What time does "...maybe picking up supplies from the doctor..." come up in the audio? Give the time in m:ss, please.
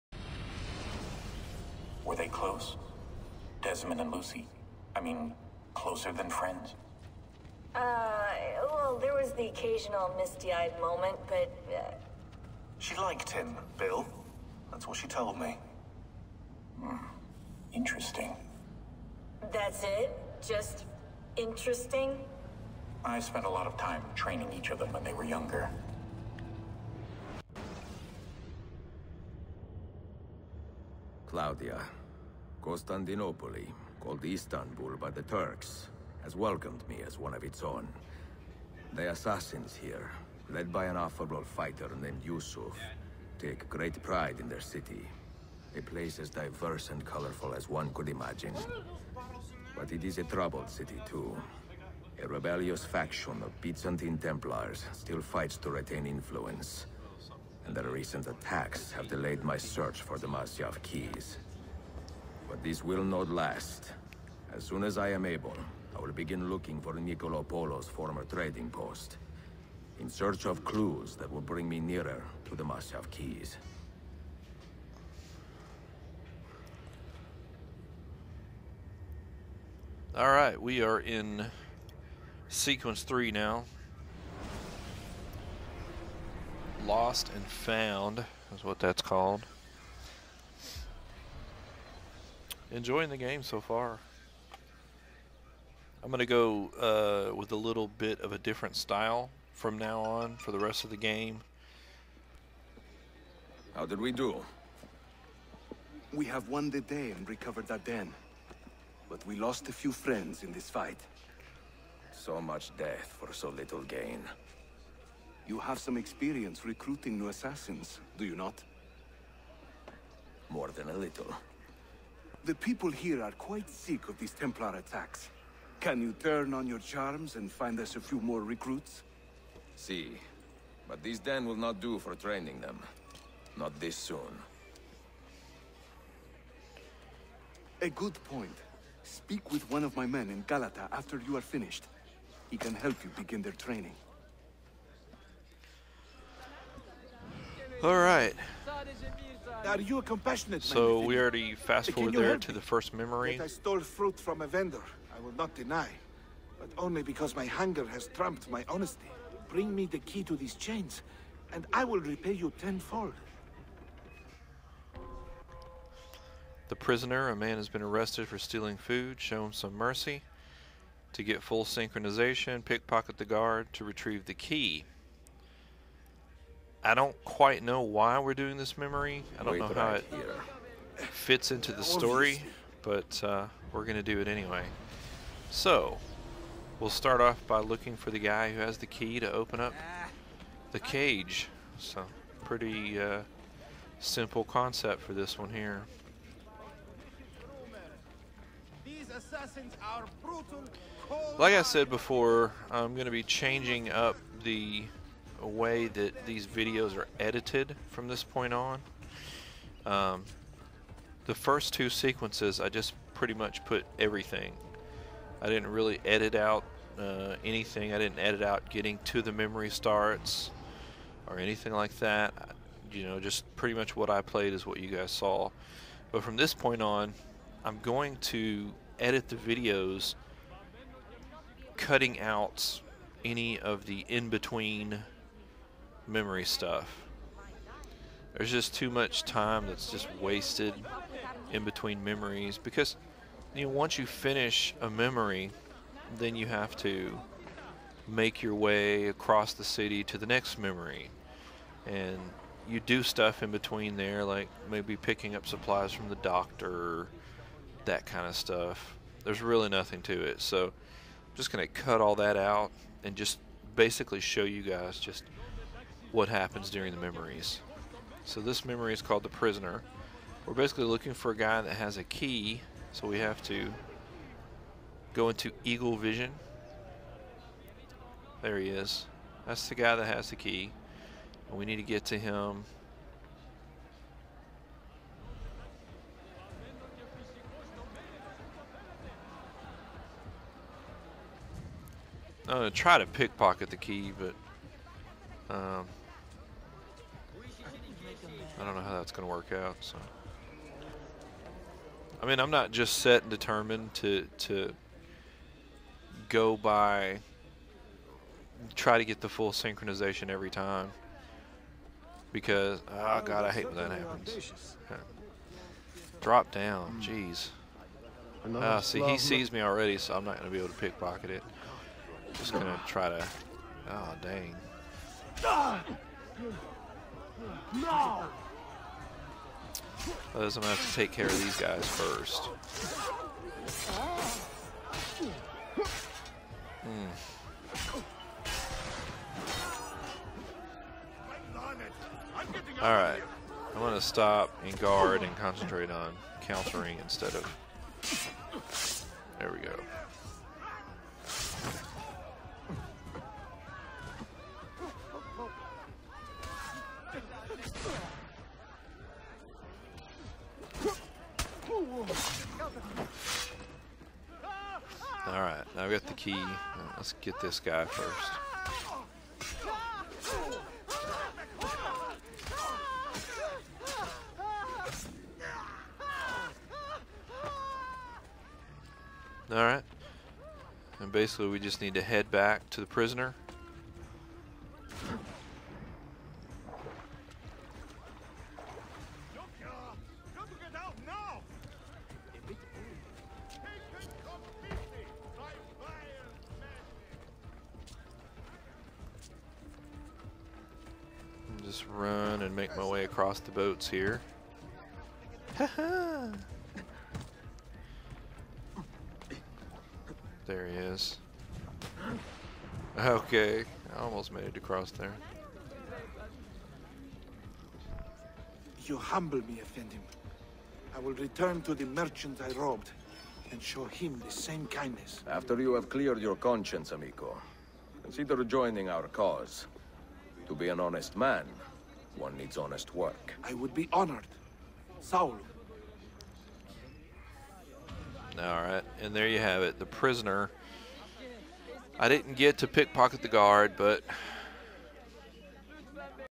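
4:14.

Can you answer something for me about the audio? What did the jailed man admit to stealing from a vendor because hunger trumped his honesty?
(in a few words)
Fruit.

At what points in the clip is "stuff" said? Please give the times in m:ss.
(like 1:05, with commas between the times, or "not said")
3:56, 4:13, 4:18.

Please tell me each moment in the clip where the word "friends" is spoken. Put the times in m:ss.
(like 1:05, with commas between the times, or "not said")
0:06, 1:49.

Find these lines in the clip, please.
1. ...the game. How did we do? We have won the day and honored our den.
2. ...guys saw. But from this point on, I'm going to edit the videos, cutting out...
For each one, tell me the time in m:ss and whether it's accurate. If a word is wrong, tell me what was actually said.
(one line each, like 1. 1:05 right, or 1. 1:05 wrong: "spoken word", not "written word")
1. 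1:40 wrong: "recovered", not "honored"
2. 3:44 right.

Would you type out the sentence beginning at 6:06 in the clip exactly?
Uh, let's get this guy first.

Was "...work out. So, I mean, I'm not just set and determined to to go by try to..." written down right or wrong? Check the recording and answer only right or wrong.
right.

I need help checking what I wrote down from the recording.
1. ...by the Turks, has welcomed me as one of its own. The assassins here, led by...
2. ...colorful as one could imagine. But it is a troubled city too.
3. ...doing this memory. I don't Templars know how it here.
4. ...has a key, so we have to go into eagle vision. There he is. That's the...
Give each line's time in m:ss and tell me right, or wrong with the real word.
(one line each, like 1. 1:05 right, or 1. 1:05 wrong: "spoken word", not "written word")
1. 0:34 right
2. 0:47 right
3. 2:58 wrong: "Wait", not "Templars"
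4. 4:31 right.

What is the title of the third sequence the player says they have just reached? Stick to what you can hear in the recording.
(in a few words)
Lost and found.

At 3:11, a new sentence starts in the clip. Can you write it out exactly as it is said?
So, pretty uh, simple concept for this one here.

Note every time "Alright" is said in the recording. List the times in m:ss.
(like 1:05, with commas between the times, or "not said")
1:20, 2:27, 5:42, 7:18.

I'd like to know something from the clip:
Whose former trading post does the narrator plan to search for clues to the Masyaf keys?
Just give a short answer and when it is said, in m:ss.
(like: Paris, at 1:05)
Niccolo Polo, at 1:06.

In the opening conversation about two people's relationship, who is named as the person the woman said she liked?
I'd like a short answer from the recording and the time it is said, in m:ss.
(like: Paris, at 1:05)
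Bill, at 0:13.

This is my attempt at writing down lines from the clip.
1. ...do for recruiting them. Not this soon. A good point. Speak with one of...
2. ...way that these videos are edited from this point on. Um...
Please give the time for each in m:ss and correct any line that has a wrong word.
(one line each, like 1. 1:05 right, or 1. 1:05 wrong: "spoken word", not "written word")
1. 2:11 wrong: "training", not "recruiting"
2. 3:25 right.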